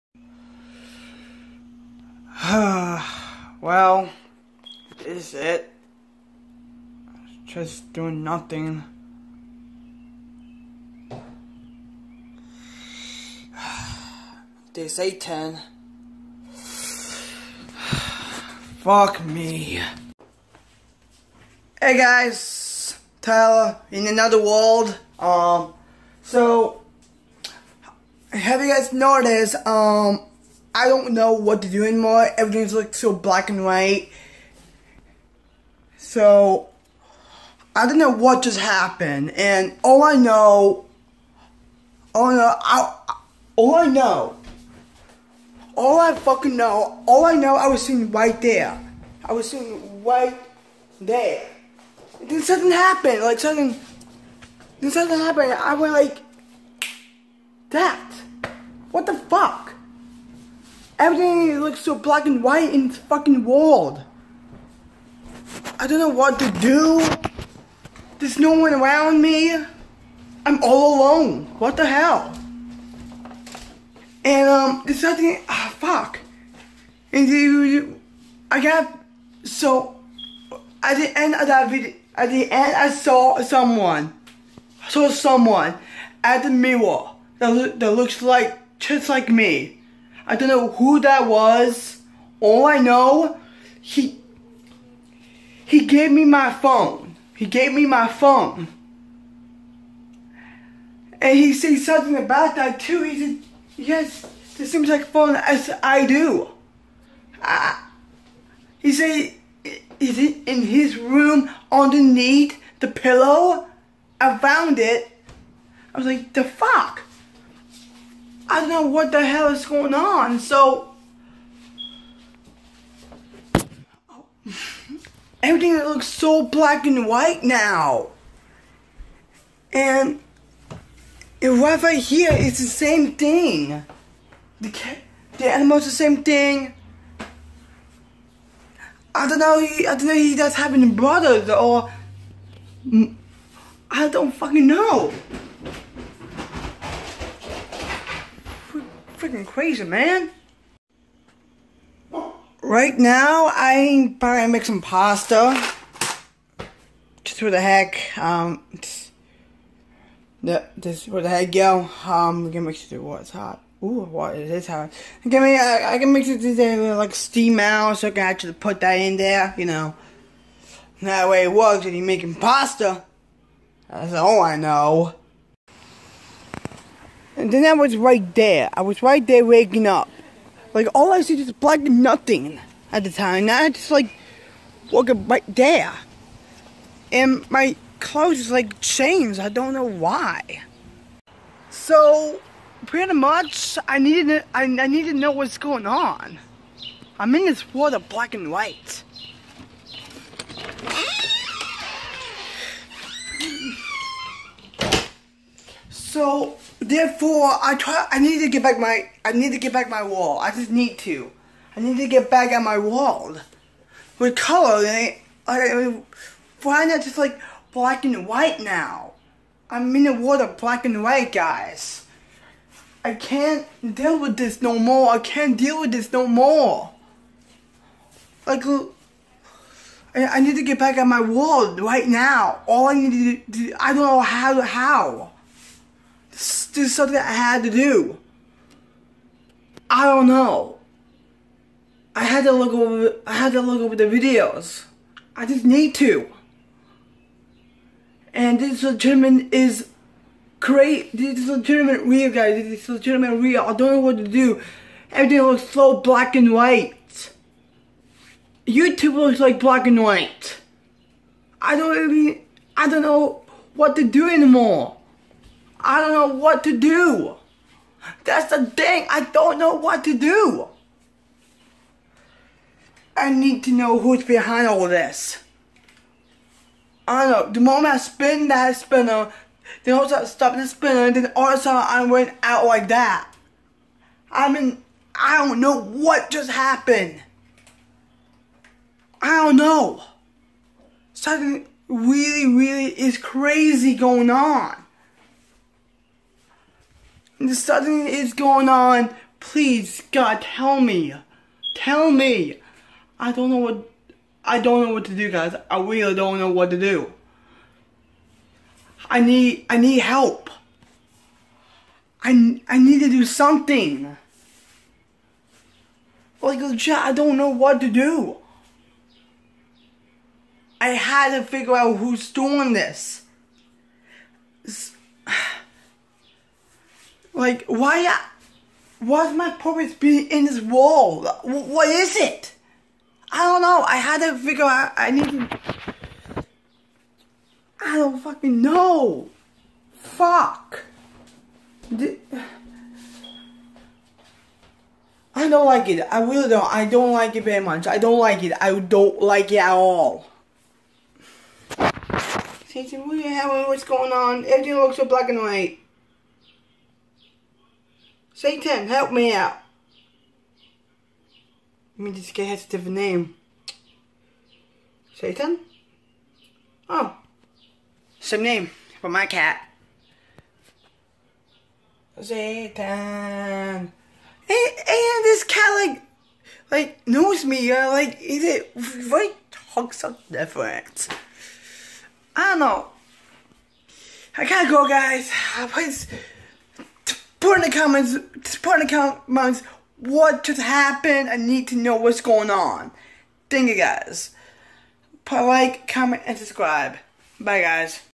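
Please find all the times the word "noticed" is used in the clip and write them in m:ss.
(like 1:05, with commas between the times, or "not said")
0:28.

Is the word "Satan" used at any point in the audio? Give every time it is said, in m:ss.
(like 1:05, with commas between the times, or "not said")
5:58, 6:05, 6:12.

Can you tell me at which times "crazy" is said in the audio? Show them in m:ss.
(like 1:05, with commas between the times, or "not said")
2:29, 4:53.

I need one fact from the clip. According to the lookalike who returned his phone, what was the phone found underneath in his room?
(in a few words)
The pillow.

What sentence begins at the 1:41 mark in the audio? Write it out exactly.
And he said something about that too.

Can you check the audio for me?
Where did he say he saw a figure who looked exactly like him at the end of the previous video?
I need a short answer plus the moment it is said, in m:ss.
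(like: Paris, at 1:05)
At the mirror, at 1:26.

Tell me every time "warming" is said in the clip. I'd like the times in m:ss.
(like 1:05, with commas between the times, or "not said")
not said.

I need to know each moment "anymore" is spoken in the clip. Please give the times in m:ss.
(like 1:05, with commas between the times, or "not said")
0:31, 4:24.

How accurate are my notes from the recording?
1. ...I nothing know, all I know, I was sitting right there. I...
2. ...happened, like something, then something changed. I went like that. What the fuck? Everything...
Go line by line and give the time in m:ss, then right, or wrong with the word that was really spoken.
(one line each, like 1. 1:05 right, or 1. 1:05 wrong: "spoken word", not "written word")
1. 0:45 wrong: "fucking", not "nothing"
2. 0:52 wrong: "happened", not "changed".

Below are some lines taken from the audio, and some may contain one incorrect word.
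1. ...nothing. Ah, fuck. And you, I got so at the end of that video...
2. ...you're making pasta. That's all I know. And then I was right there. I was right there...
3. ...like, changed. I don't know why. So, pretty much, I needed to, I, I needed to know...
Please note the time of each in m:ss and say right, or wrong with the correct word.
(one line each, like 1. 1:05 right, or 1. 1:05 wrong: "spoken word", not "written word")
1. 1:15 right
2. 2:51 right
3. 3:08 right.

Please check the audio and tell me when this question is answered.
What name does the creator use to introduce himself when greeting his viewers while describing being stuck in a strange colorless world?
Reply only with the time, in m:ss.
0:23.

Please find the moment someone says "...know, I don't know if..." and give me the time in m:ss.
2:19.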